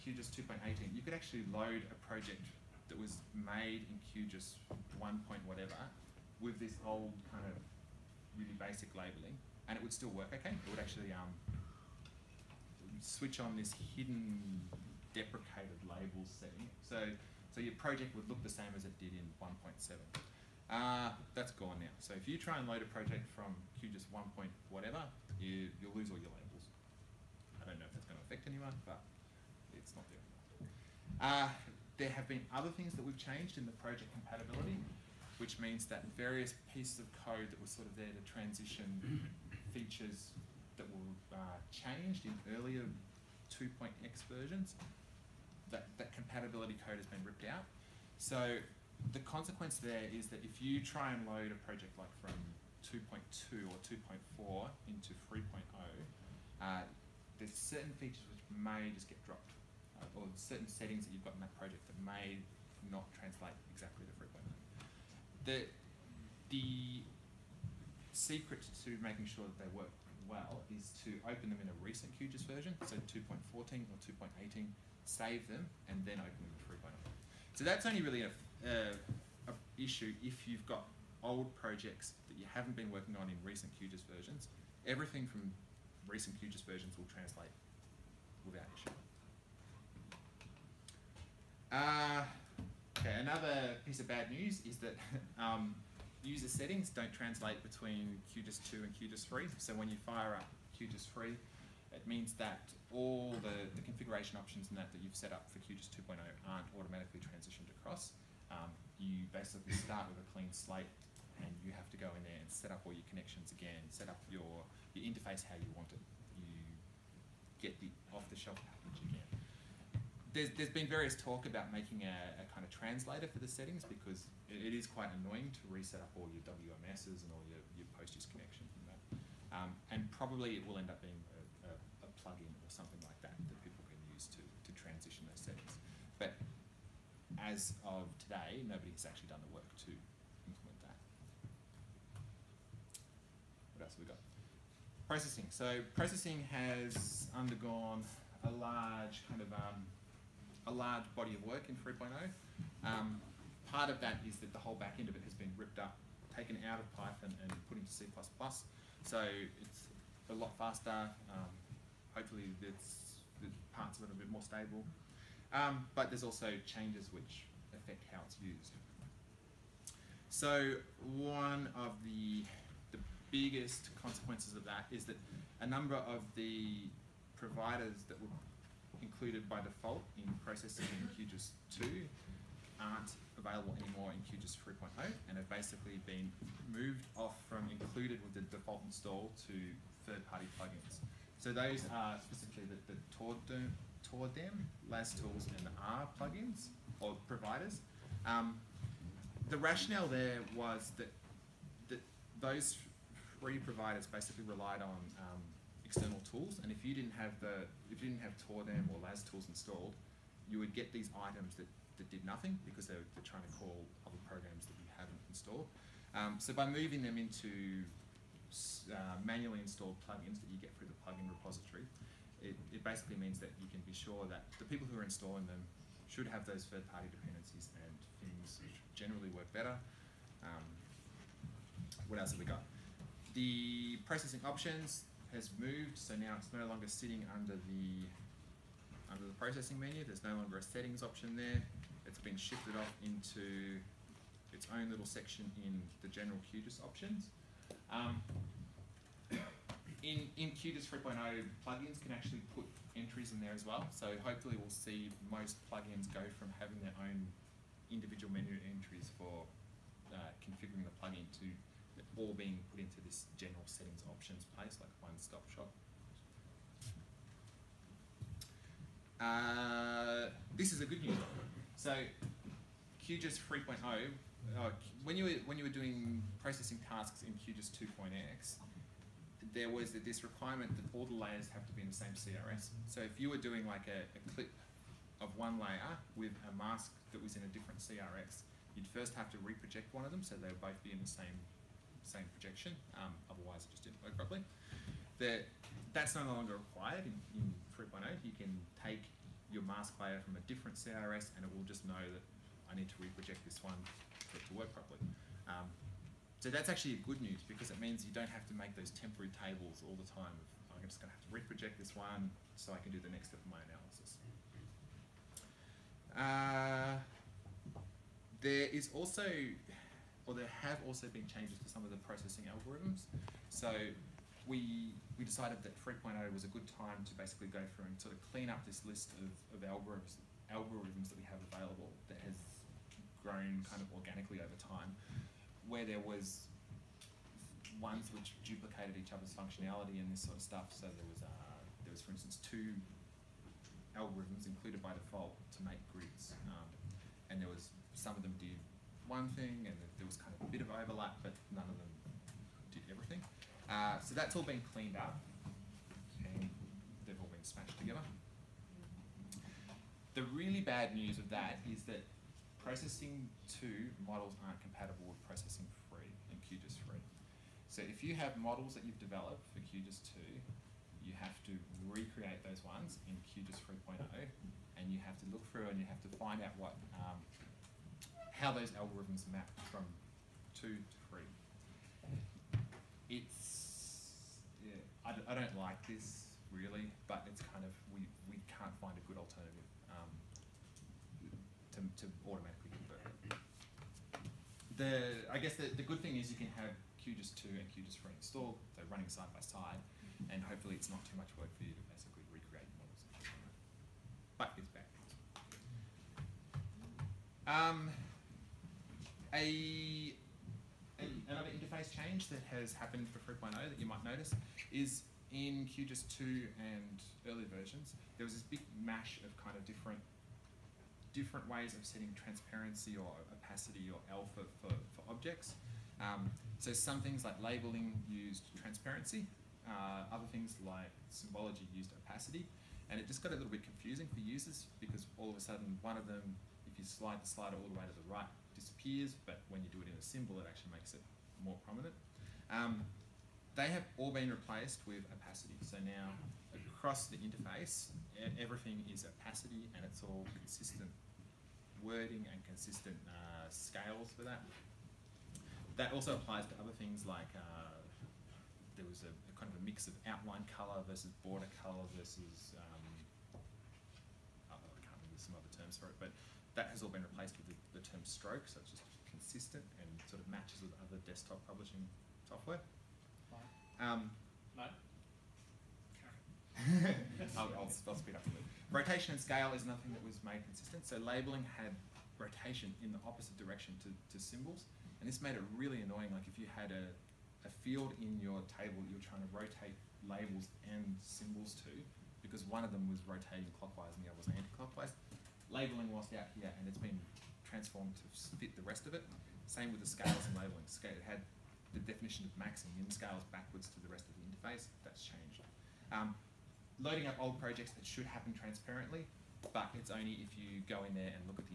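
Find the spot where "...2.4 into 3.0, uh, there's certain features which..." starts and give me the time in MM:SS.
00:53.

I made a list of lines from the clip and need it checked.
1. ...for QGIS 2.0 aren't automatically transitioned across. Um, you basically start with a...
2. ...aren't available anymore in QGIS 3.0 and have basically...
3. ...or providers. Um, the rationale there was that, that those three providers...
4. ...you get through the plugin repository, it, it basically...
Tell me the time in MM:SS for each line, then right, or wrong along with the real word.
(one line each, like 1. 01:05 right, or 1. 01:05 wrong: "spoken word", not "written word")
1. 01:45 right
2. 03:02 right
3. 03:17 right
4. 03:40 right.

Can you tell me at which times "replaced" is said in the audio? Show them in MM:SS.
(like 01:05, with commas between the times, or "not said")
07:24, 07:47.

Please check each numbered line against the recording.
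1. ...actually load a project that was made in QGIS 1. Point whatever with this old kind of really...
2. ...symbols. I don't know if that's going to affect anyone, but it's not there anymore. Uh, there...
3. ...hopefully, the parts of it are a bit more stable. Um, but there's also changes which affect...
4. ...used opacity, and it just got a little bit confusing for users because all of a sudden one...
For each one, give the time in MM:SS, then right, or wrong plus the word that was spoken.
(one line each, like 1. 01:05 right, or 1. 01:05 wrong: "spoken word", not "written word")
1. 00:01 right
2. 00:26 wrong: "labels", not "symbols"
3. 02:42 right
4. 07:11 right.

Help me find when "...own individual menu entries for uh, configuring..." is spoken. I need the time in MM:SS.
04:17.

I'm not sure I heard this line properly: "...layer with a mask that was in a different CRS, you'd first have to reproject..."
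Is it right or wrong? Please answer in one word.
right.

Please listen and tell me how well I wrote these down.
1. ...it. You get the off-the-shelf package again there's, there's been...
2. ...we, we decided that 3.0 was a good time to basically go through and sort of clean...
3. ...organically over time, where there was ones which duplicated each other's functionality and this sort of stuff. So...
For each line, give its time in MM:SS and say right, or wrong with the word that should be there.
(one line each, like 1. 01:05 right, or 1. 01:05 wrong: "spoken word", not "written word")
1. 01:55 right
2. 05:24 right
3. 05:33 right.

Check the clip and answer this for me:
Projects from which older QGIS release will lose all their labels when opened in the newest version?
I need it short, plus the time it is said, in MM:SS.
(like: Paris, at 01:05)
QGIS 1.7, at 00:19.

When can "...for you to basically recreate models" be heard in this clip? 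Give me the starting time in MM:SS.
06:41.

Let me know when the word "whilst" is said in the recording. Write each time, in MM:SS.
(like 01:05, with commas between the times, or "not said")
08:15.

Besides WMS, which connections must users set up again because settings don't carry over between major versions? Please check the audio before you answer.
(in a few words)
PostGIS connections.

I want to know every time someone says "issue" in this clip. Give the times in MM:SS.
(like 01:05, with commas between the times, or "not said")
01:19, 01:28.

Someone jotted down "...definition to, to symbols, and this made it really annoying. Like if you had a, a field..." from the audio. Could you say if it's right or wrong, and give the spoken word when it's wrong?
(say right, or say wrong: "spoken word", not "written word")
wrong: "direction", not "definition".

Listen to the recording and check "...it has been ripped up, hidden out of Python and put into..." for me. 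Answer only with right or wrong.
wrong.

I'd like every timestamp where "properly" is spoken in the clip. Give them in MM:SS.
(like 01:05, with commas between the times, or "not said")
04:54, 05:04.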